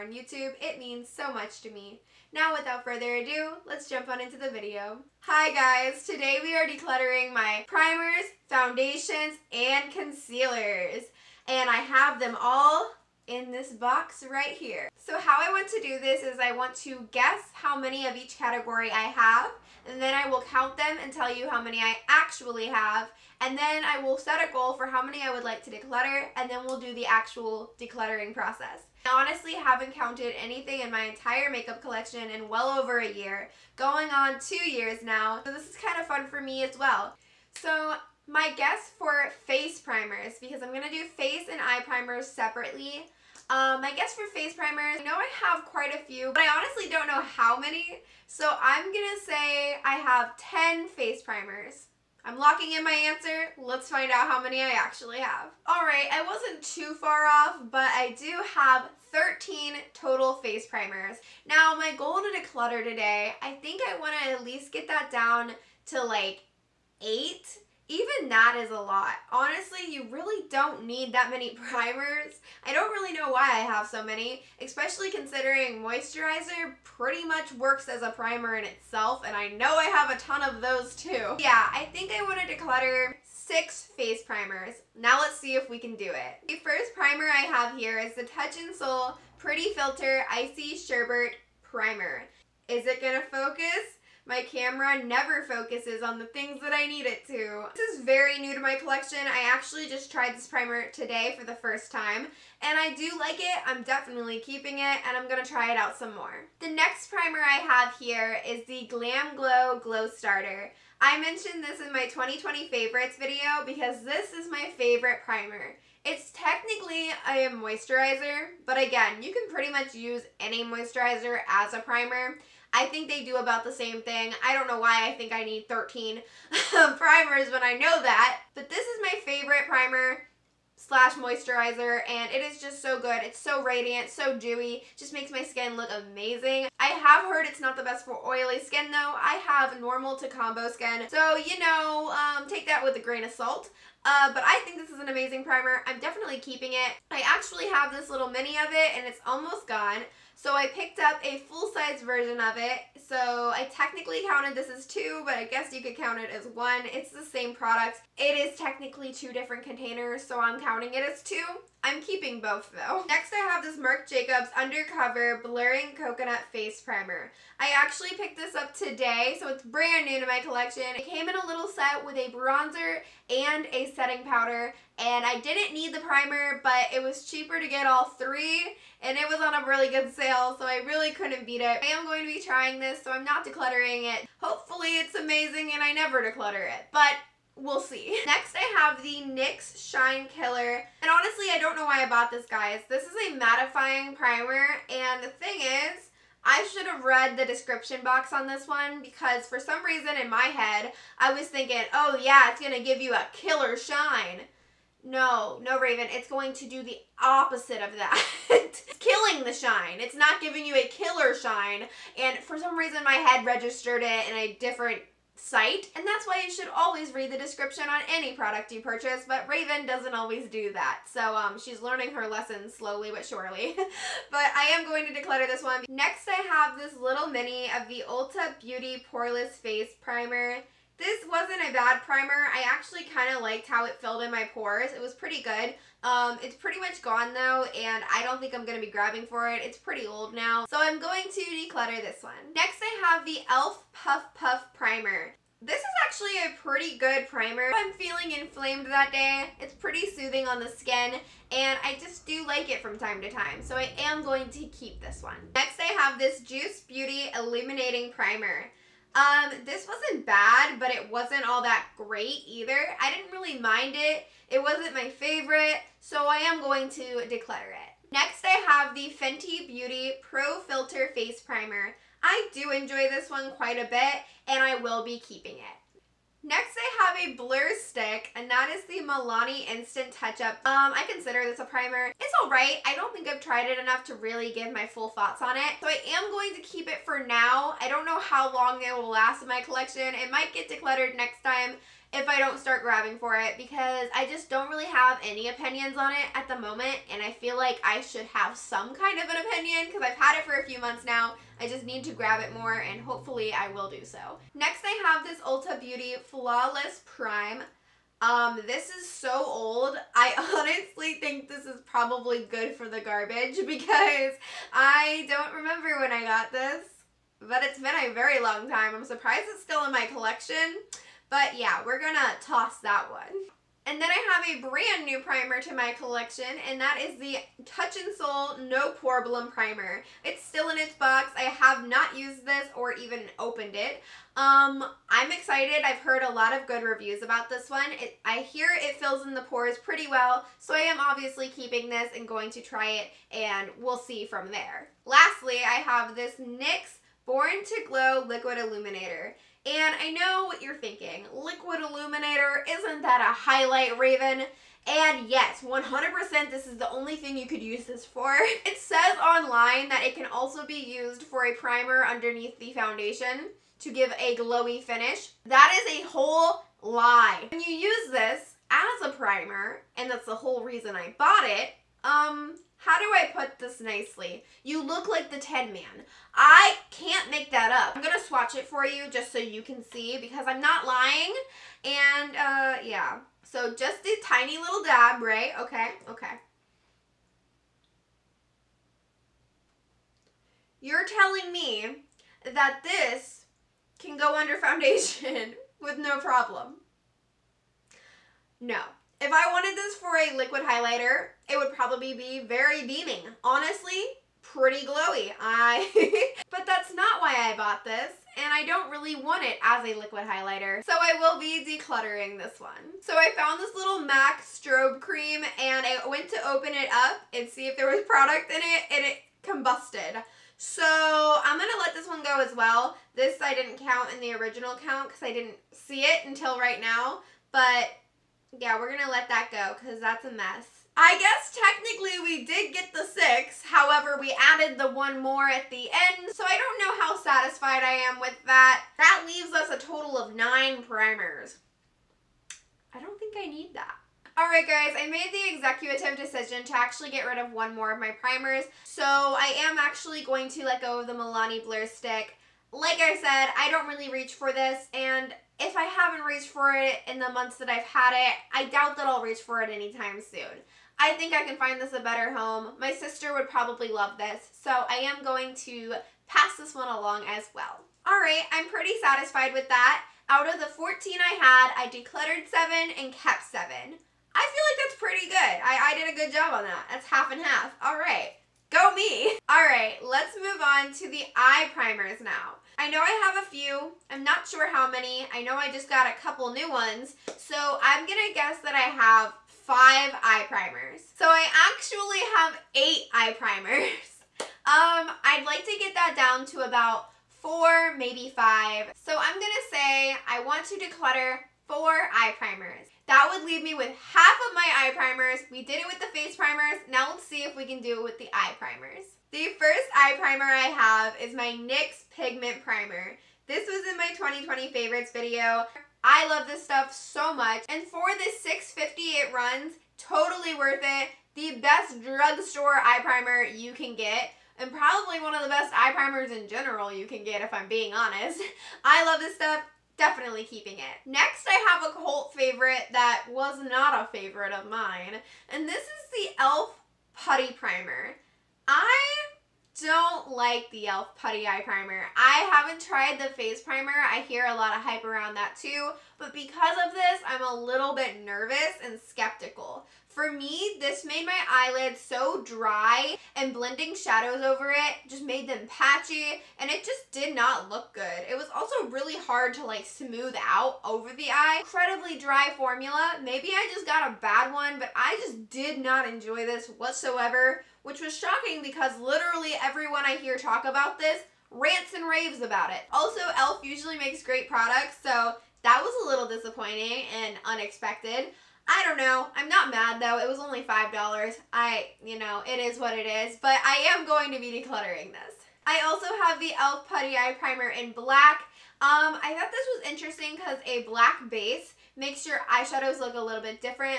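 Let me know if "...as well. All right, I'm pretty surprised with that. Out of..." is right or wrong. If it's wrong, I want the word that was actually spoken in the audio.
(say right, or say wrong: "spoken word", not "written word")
wrong: "satisfied", not "surprised".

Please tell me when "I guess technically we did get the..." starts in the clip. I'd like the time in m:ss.
7:10.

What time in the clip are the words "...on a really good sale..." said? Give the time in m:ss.
2:59.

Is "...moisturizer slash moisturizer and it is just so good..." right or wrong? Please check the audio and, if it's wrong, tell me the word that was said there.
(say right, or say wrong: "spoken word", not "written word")
wrong: "primer", not "moisturizer".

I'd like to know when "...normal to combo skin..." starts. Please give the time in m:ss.
2:19.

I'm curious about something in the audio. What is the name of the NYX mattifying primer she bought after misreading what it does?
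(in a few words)
Shine Killer.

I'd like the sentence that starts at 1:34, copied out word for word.
My camera never focuses on the things that I need it to.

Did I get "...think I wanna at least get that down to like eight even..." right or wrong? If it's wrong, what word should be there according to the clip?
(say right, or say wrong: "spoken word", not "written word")
right.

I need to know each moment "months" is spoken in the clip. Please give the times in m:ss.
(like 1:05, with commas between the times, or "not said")
5:00, 7:37.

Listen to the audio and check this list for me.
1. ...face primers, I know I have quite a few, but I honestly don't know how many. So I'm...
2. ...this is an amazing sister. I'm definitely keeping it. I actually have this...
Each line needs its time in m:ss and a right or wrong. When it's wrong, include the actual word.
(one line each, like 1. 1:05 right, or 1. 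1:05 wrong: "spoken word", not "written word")
1. 0:44 right
2. 2:24 wrong: "primer", not "sister".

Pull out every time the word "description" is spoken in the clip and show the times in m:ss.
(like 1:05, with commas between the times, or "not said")
3:17, 3:37.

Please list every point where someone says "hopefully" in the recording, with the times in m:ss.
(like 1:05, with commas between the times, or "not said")
3:04, 5:03.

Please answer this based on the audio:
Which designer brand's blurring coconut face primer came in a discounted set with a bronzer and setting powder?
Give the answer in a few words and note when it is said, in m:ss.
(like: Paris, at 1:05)
Marc Jacobs, at 2:43.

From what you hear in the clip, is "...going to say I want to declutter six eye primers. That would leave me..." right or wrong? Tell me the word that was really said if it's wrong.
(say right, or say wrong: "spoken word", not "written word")
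wrong: "four", not "six".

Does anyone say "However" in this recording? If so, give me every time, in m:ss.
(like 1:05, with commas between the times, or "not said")
7:13.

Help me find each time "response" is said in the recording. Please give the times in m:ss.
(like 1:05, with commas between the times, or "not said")
not said.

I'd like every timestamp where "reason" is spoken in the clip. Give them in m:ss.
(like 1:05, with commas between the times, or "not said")
3:19, 3:32, 6:10.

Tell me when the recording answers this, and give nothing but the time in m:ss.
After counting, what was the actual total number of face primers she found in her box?
0:59.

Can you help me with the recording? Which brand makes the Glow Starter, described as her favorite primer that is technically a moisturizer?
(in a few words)
Glam Glow.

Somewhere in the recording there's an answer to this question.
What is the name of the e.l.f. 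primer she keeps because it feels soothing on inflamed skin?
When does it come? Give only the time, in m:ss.
4:03.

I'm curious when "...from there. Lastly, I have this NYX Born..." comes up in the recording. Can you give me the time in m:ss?
5:44.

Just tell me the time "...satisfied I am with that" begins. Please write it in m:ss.
7:17.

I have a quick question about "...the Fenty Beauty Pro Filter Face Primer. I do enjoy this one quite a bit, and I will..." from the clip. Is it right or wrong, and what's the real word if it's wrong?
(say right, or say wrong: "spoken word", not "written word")
right.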